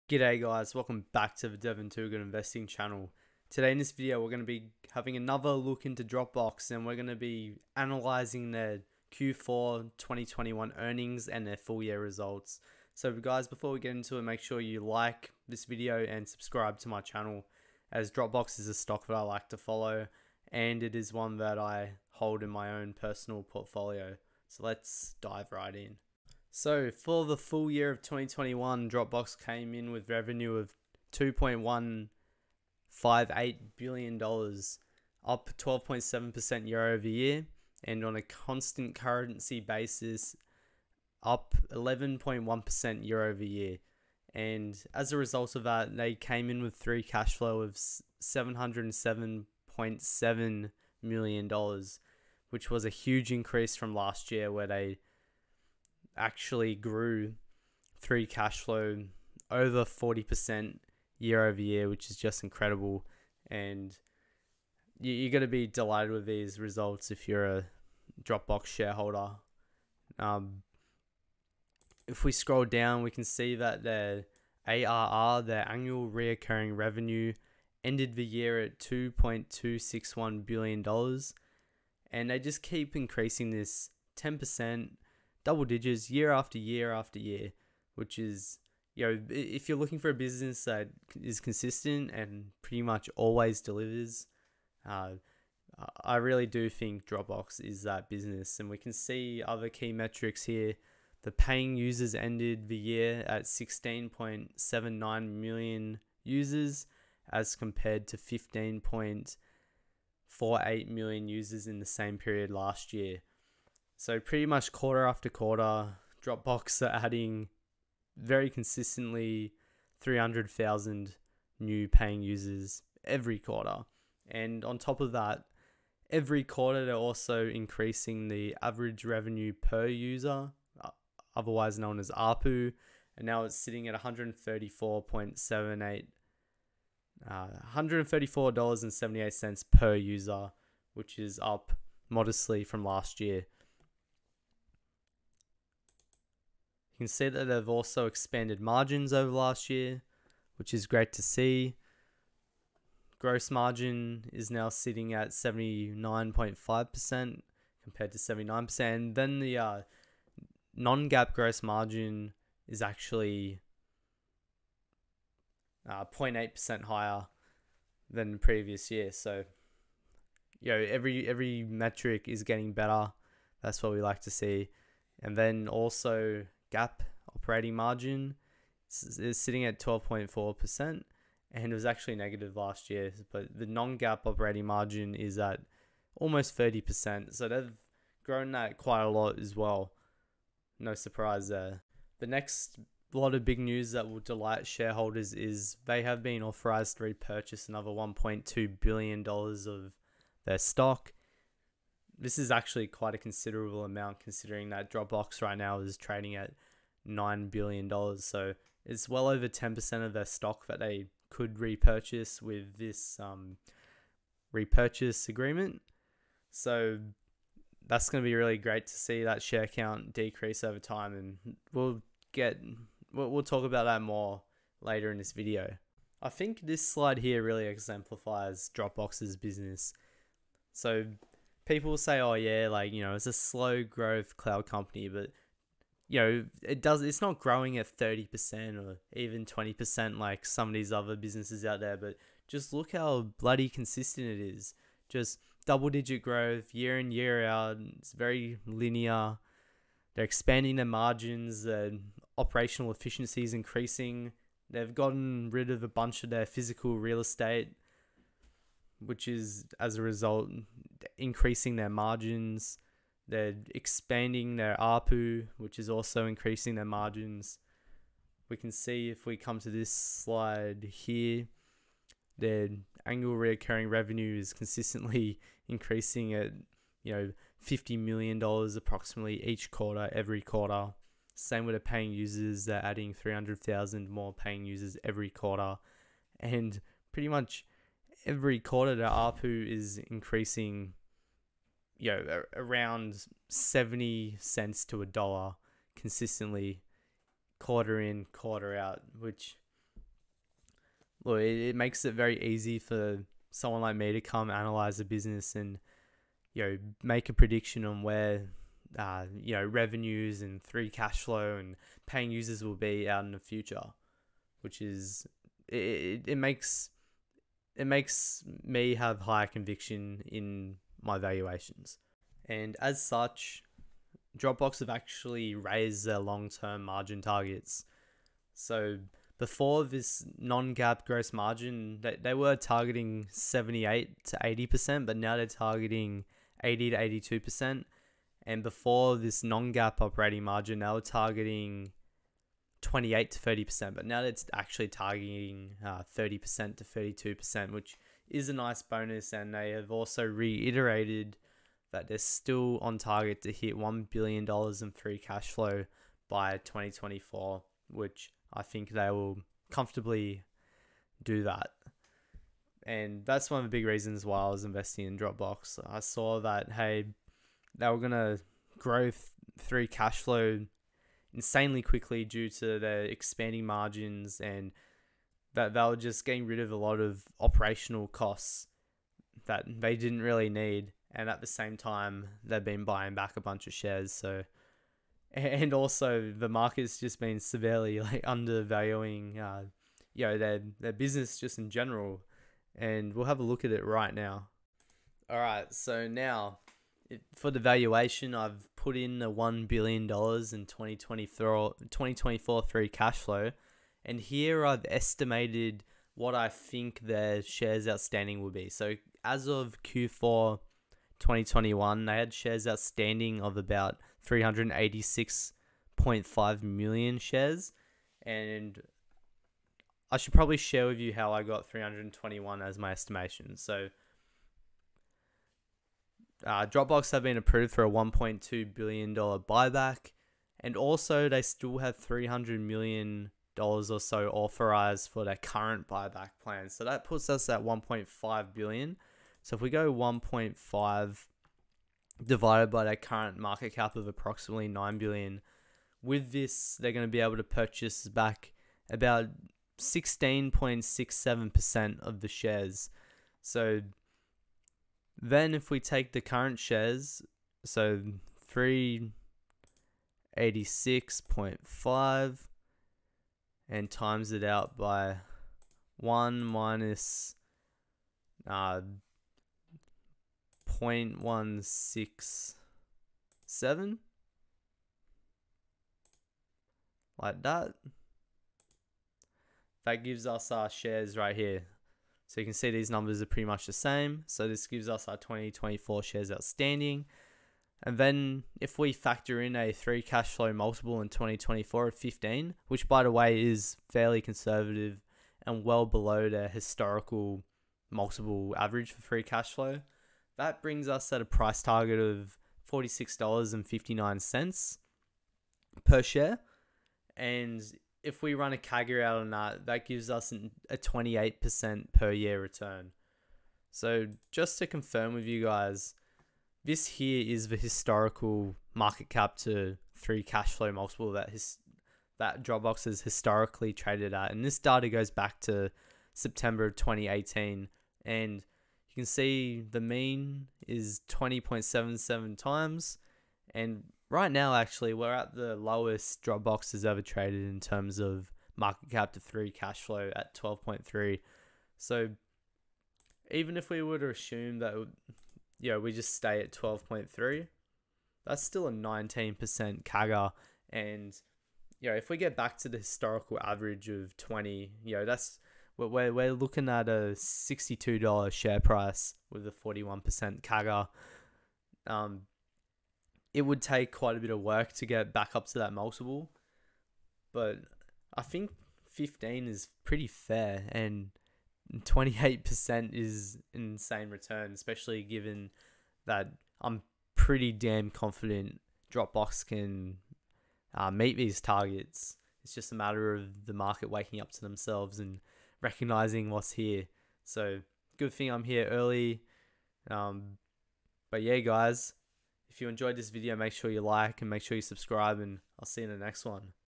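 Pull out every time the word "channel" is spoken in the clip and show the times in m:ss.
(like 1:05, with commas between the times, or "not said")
0:02, 0:16.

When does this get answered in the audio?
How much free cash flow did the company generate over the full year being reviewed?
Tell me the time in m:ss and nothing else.
0:48.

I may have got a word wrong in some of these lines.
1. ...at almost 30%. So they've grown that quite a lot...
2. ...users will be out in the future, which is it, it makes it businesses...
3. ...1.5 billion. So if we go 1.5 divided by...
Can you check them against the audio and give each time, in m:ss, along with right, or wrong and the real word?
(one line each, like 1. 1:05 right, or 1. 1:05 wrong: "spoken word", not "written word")
1. 3:05 right
2. 5:12 wrong: "makes", not "businesses"
3. 7:17 right.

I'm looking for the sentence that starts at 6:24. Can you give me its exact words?
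So, and also the market's just been severely like undervaluing, uh, you know, their their business just in general.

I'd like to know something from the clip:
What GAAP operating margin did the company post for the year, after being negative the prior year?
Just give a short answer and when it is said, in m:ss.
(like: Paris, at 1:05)
12.4%, at 2:59.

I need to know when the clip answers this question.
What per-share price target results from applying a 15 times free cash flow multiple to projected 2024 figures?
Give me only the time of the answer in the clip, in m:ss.
8:22.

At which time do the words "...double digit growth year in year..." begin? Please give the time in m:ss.
4:05.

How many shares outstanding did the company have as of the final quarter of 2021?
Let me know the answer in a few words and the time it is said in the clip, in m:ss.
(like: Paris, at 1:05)
386.5 million, at 6:54.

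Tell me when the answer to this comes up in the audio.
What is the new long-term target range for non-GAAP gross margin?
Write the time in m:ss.
5:36.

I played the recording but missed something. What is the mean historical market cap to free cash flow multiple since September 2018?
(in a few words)
20.77.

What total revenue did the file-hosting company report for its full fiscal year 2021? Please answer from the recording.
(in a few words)
$2.158 billion.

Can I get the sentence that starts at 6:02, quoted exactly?
And that's one of the big reasons why I was investing in Dropbox.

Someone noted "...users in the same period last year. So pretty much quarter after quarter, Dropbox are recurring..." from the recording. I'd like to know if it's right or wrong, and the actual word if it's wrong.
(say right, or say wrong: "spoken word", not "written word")
wrong: "adding", not "recurring".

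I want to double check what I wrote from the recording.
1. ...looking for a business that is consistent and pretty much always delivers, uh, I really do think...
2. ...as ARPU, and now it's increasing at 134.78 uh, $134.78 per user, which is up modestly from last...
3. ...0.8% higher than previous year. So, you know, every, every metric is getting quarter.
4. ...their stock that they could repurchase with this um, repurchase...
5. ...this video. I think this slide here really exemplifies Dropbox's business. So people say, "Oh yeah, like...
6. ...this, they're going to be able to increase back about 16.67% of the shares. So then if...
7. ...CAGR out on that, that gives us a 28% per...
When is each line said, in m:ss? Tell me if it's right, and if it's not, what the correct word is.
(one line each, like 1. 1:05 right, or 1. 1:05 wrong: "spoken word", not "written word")
1. 1:29 right
2. 2:11 wrong: "sitting", not "increasing"
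3. 2:46 wrong: "better", not "quarter"
4. 3:30 right
5. 3:45 right
6. 7:26 wrong: "purchase", not "increase"
7. 8:28 right.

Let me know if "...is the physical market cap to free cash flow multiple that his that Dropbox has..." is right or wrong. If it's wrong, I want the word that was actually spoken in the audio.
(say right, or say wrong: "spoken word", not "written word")
wrong: "historical", not "physical".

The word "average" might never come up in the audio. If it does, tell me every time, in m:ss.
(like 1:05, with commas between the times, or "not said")
2:08, 8:18, 9:13.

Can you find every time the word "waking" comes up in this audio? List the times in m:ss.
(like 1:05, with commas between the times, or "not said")
9:43.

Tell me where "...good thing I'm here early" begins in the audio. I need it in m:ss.
9:47.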